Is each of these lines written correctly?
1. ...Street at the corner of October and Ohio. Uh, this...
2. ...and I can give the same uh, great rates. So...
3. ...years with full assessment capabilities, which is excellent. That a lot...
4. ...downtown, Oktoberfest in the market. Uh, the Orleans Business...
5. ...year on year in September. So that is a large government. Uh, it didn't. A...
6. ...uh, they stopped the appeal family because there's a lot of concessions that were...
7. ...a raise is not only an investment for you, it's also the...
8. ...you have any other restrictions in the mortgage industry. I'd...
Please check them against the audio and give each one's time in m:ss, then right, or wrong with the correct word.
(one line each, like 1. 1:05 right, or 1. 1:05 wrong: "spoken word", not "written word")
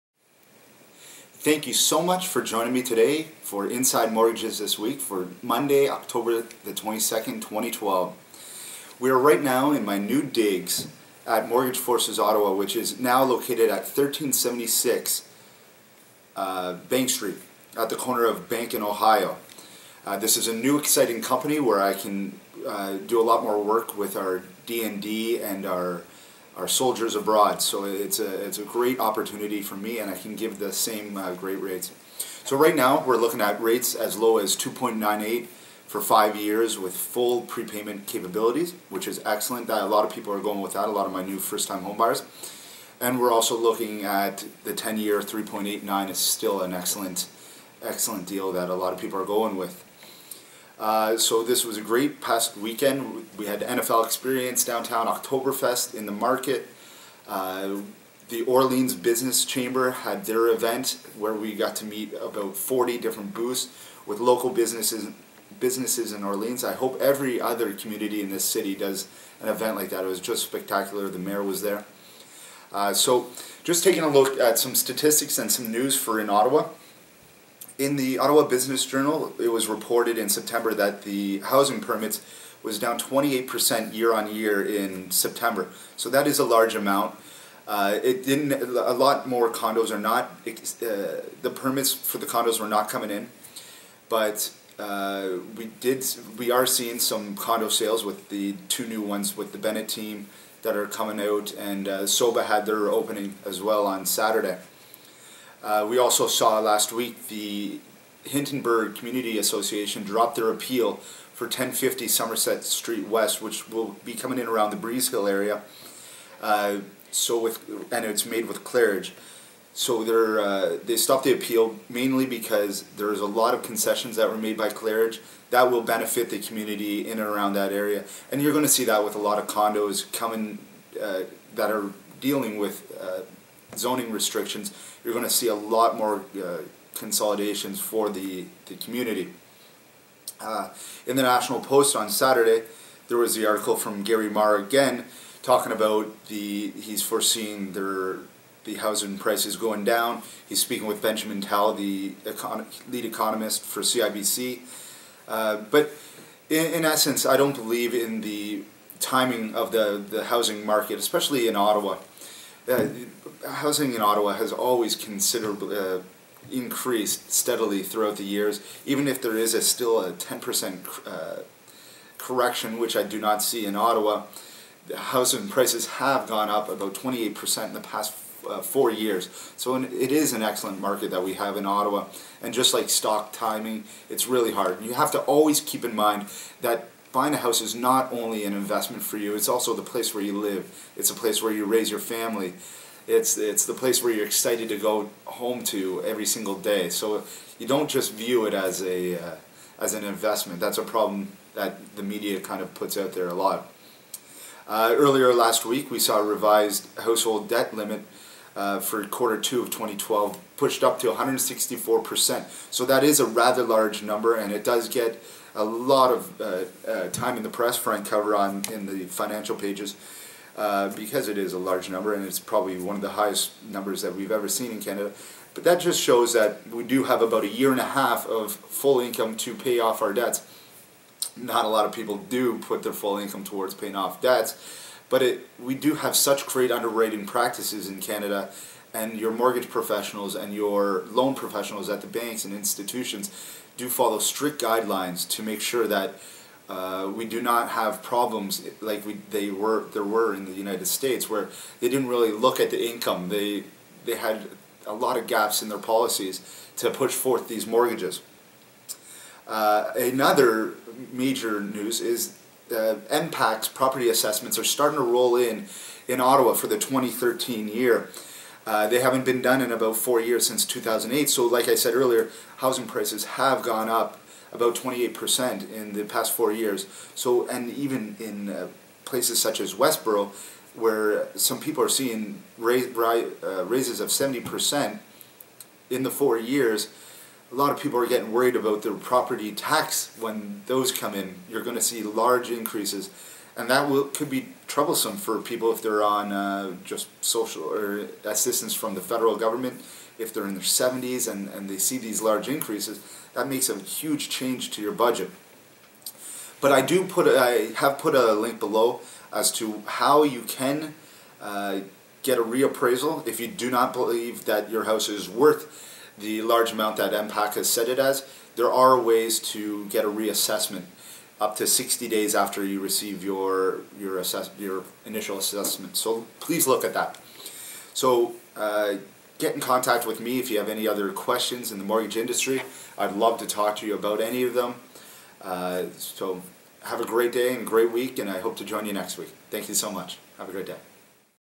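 1. 0:17 wrong: "Bank", not "October"
2. 0:29 right
3. 0:36 wrong: "prepayment", not "assessment"
4. 0:54 right
5. 1:23 wrong: "amount", not "government"
6. 2:00 wrong: "mainly", not "family"
7. 3:07 wrong: "house", not "raise"
8. 5:30 wrong: "questions", not "restrictions".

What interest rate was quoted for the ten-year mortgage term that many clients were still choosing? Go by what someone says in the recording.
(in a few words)
3.89.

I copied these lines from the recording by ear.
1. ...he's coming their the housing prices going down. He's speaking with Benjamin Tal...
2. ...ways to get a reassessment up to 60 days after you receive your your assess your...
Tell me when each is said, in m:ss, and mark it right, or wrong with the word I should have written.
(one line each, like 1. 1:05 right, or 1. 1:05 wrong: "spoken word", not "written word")
1. 2:26 wrong: "foreseeing", not "coming"
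2. 5:18 right.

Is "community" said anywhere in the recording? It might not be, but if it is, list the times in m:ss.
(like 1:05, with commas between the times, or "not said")
1:07, 1:48, 2:06, 2:18.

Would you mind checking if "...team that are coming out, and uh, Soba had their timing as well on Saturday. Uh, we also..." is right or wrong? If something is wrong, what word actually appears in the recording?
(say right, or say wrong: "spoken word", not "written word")
wrong: "opening", not "timing".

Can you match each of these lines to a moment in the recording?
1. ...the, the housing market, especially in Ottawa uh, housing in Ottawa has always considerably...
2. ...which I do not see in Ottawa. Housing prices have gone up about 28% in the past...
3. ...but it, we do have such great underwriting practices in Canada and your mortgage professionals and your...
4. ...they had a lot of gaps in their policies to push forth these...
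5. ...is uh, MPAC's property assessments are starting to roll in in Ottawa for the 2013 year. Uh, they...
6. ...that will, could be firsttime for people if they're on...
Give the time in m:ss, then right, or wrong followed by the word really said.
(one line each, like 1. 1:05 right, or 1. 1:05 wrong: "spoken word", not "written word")
1. 2:39 right
2. 2:52 right
3. 3:55 right
4. 4:14 right
5. 4:21 right
6. 4:53 wrong: "troublesome", not "firsttime".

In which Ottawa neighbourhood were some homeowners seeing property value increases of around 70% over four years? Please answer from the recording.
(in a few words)
Westboro.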